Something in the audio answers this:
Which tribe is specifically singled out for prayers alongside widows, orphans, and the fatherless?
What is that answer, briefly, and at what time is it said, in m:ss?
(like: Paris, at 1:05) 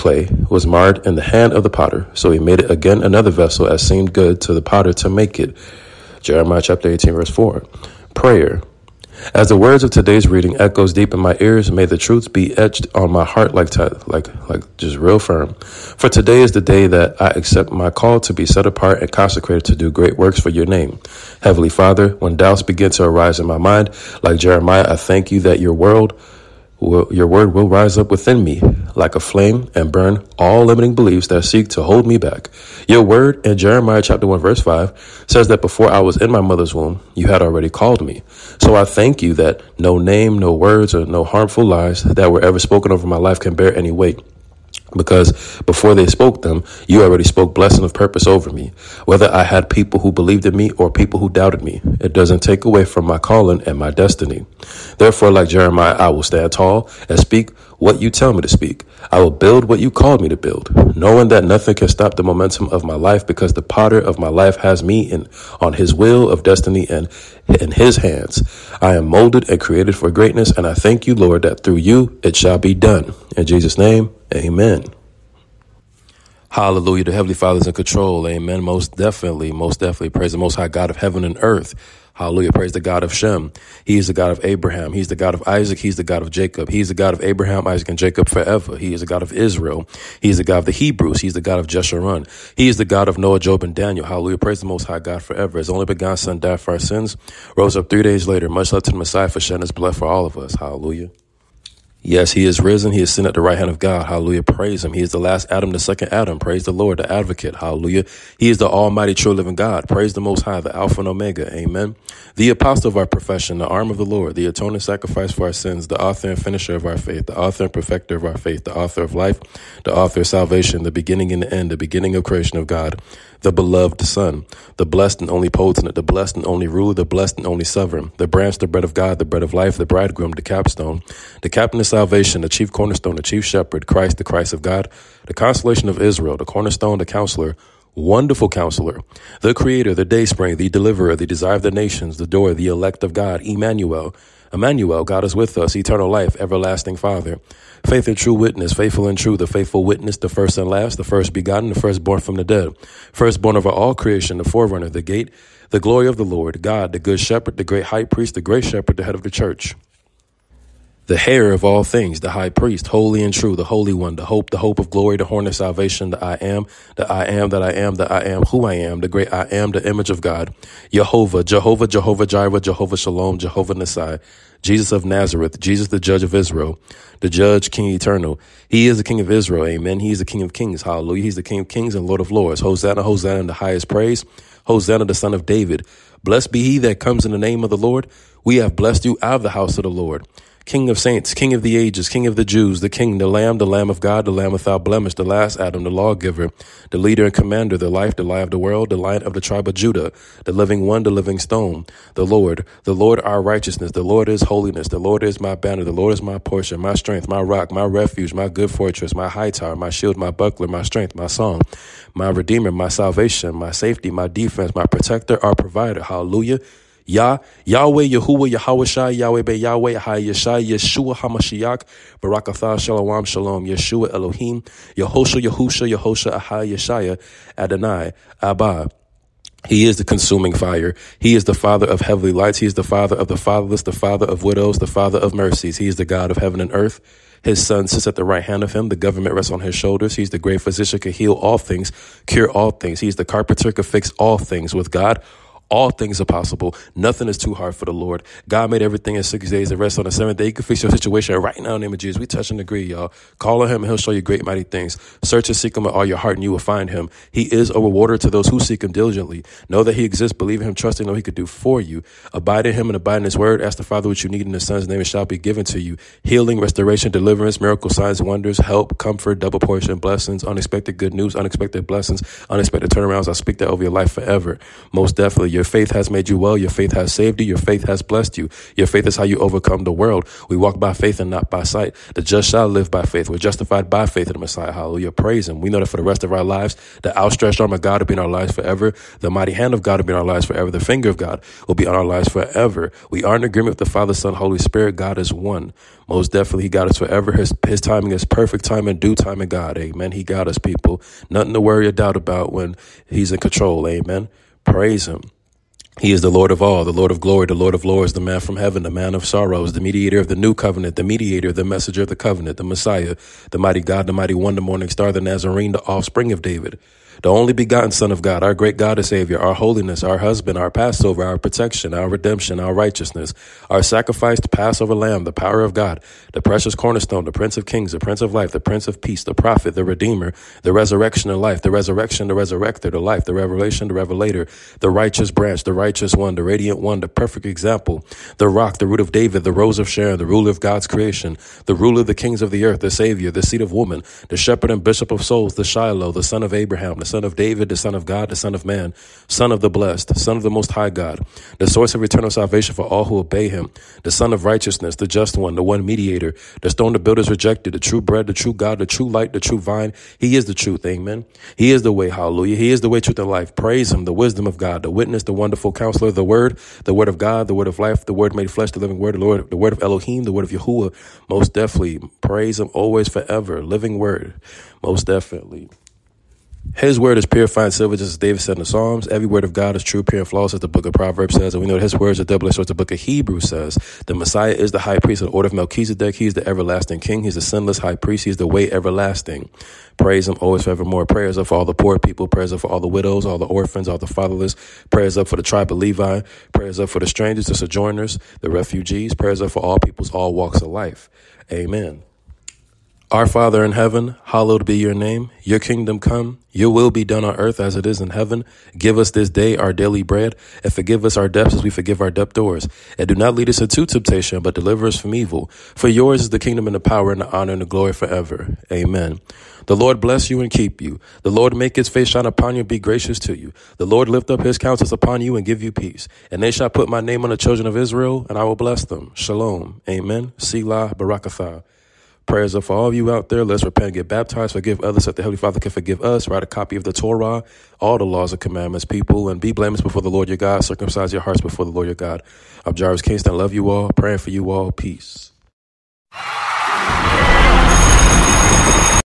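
Levi, at 6:35.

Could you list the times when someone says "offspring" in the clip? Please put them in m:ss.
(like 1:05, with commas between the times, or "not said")
5:15.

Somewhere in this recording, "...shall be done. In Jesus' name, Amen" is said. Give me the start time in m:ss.
1:12.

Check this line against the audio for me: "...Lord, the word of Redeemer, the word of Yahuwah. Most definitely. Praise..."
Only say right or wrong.
wrong.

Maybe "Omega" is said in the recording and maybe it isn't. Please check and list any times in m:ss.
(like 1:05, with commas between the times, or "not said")
1:51.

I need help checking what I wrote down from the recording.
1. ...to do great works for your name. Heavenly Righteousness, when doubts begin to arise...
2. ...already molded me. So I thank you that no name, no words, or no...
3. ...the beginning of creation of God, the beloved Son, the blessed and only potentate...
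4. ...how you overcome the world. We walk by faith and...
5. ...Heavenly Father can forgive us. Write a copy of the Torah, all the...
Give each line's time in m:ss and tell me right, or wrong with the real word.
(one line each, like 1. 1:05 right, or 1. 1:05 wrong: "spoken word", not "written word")
1. 0:19 wrong: "Father", not "Righteousness"
2. 0:37 wrong: "called", not "molded"
3. 2:01 right
4. 4:39 right
5. 7:15 right.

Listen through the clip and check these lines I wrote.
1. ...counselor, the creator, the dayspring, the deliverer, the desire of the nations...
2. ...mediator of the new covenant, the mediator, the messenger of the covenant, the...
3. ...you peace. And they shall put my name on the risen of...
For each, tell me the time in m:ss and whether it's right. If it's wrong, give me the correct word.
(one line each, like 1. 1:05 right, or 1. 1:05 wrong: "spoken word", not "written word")
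1. 2:18 right
2. 5:09 right
3. 7:05 wrong: "children", not "risen".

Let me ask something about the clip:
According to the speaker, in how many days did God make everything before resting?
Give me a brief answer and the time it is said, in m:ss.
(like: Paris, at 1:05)
6, at 4:09.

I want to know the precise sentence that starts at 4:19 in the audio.
Know that he exists, believe in him, trust in what he could do for you.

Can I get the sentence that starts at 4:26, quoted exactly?
Healing, restoration, deliverance, miracle signs, wonders, help, comfort, double portion, blessings, unexpected good news, unexpected blessings, unexpected turnarounds.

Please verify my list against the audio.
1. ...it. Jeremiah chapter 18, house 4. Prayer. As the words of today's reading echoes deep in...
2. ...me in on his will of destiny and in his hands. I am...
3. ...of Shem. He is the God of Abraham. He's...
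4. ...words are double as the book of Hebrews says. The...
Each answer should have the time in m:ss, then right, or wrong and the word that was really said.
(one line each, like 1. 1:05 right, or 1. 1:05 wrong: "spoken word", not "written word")
1. 0:05 wrong: "verse", not "house"
2. 1:04 right
3. 1:23 right
4. 6:21 right.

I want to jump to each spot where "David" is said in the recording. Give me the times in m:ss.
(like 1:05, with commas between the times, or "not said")
3:05, 5:16, 5:39, 5:47, 6:18.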